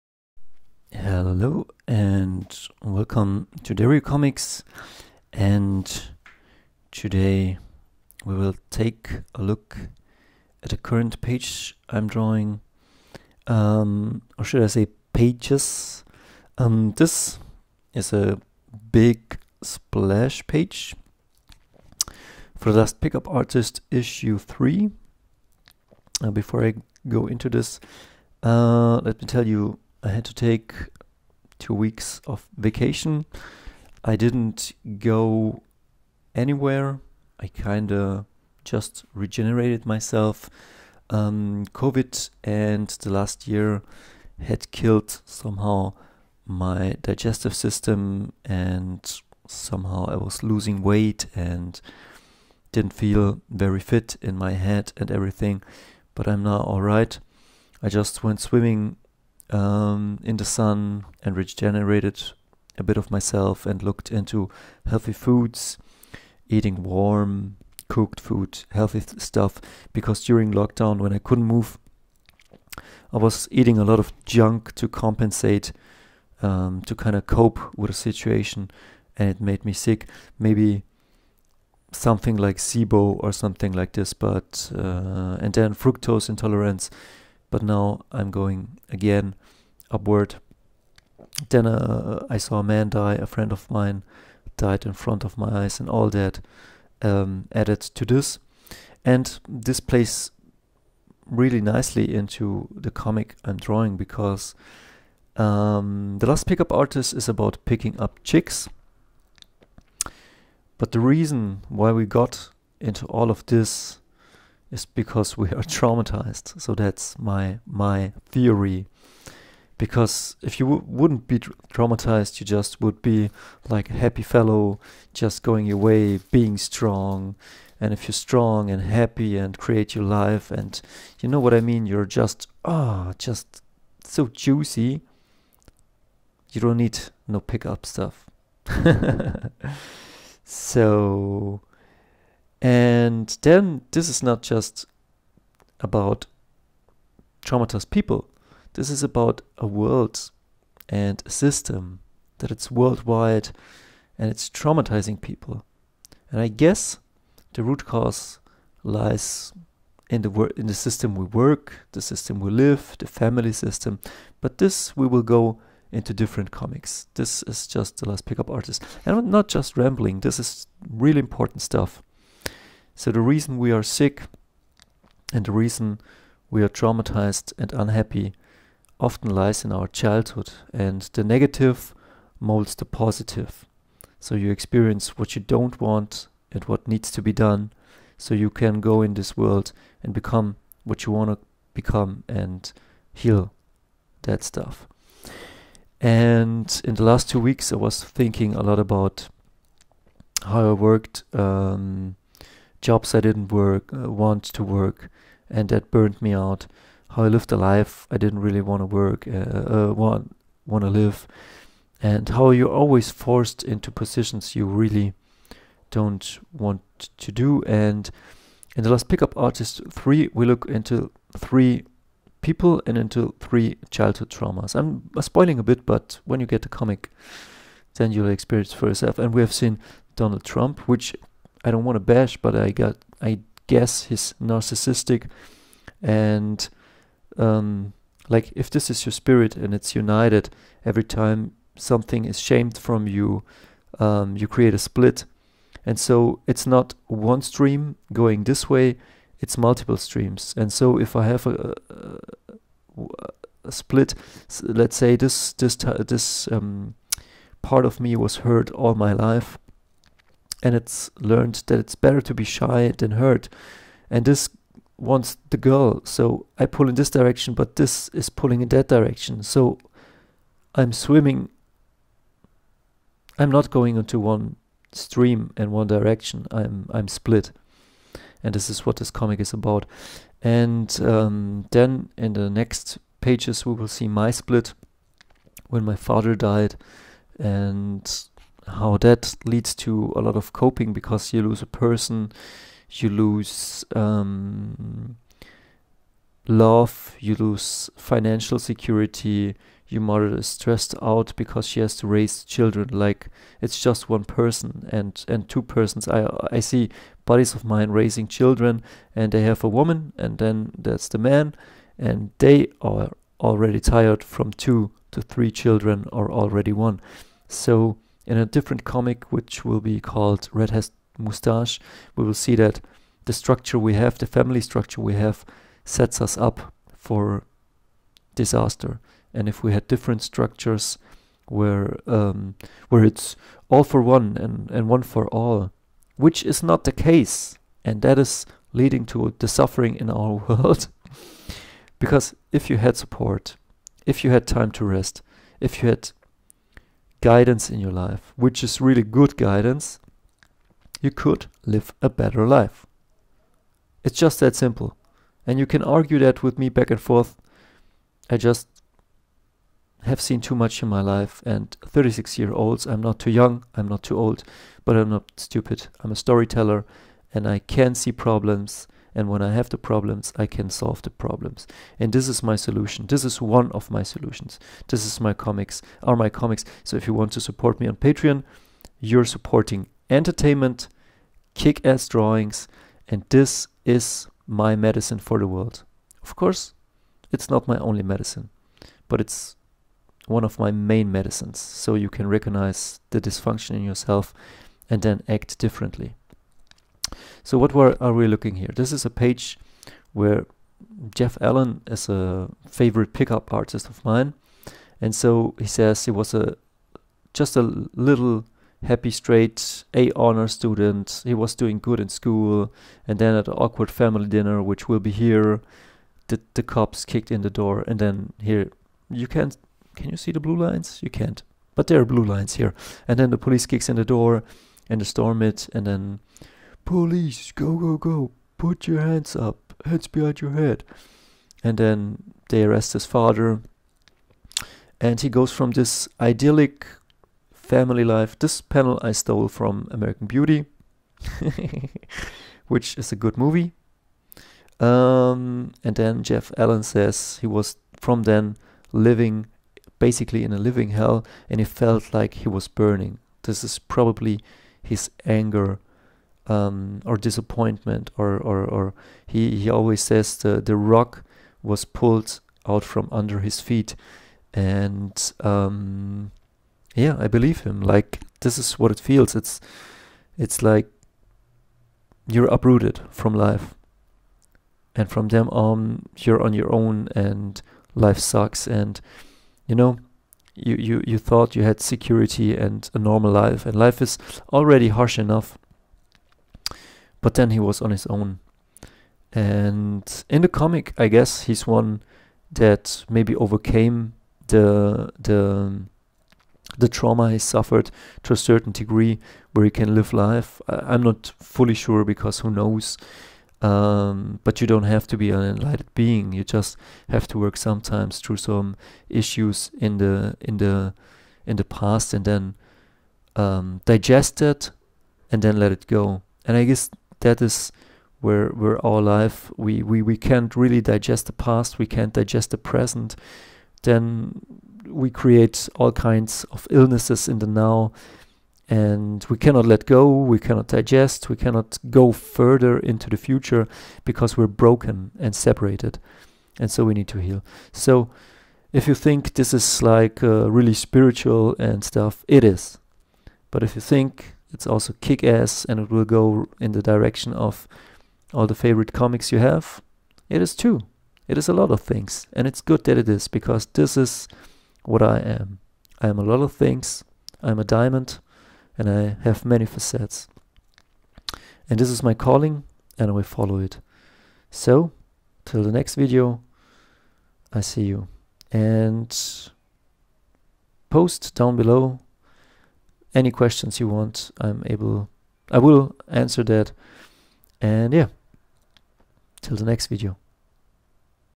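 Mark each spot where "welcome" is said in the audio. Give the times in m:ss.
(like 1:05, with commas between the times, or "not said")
0:02.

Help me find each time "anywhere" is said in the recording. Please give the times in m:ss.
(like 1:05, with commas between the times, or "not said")
0:36.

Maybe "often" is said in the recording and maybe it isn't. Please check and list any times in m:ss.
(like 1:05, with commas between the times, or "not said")
2:58.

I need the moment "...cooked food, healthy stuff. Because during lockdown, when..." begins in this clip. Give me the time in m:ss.
1:07.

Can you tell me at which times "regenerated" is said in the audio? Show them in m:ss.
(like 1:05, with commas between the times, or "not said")
0:39, 1:01.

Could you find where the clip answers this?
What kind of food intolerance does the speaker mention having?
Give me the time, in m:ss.
1:25.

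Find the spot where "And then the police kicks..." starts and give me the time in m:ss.
7:03.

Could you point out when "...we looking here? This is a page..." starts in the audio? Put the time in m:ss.
6:38.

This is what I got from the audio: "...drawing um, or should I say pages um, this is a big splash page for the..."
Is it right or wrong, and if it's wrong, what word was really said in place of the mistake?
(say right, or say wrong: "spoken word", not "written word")
right.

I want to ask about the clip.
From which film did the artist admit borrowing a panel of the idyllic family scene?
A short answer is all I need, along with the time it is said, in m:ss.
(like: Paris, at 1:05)
American Beauty, at 7:19.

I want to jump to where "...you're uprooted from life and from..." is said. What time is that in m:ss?
7:52.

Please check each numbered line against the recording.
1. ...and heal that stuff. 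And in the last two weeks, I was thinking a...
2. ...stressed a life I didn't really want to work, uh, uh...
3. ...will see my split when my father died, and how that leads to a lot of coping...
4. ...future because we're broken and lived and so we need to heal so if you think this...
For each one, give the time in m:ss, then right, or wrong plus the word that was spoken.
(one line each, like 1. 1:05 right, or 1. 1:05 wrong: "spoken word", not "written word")
1. 3:12 right
2. 3:27 wrong: "lived", not "stressed"
3. 4:43 right
4. 8:53 wrong: "separated", not "lived".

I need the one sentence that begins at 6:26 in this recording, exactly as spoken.
Of course, it's not my only medicine, but it's one of my main medicines.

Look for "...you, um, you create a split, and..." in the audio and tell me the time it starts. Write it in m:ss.
4:03.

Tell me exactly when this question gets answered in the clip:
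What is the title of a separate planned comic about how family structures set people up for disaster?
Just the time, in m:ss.
5:20.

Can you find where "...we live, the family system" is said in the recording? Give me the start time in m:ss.
2:42.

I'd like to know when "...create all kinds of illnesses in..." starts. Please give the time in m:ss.
8:45.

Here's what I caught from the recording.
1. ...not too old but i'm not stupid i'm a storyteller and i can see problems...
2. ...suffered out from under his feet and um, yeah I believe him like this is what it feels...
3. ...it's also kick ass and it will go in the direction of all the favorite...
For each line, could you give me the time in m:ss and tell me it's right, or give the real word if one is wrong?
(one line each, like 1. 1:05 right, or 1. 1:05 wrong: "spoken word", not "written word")
1. 6:03 right
2. 7:41 wrong: "pulled", not "suffered"
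3. 9:04 right.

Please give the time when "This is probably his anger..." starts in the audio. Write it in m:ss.
7:33.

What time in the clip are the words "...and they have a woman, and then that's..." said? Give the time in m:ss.
5:09.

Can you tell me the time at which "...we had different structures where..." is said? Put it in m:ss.
5:29.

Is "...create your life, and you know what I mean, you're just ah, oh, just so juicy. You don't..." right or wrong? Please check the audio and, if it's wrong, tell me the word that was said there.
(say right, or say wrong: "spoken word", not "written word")
right.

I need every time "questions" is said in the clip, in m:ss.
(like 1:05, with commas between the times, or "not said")
9:33.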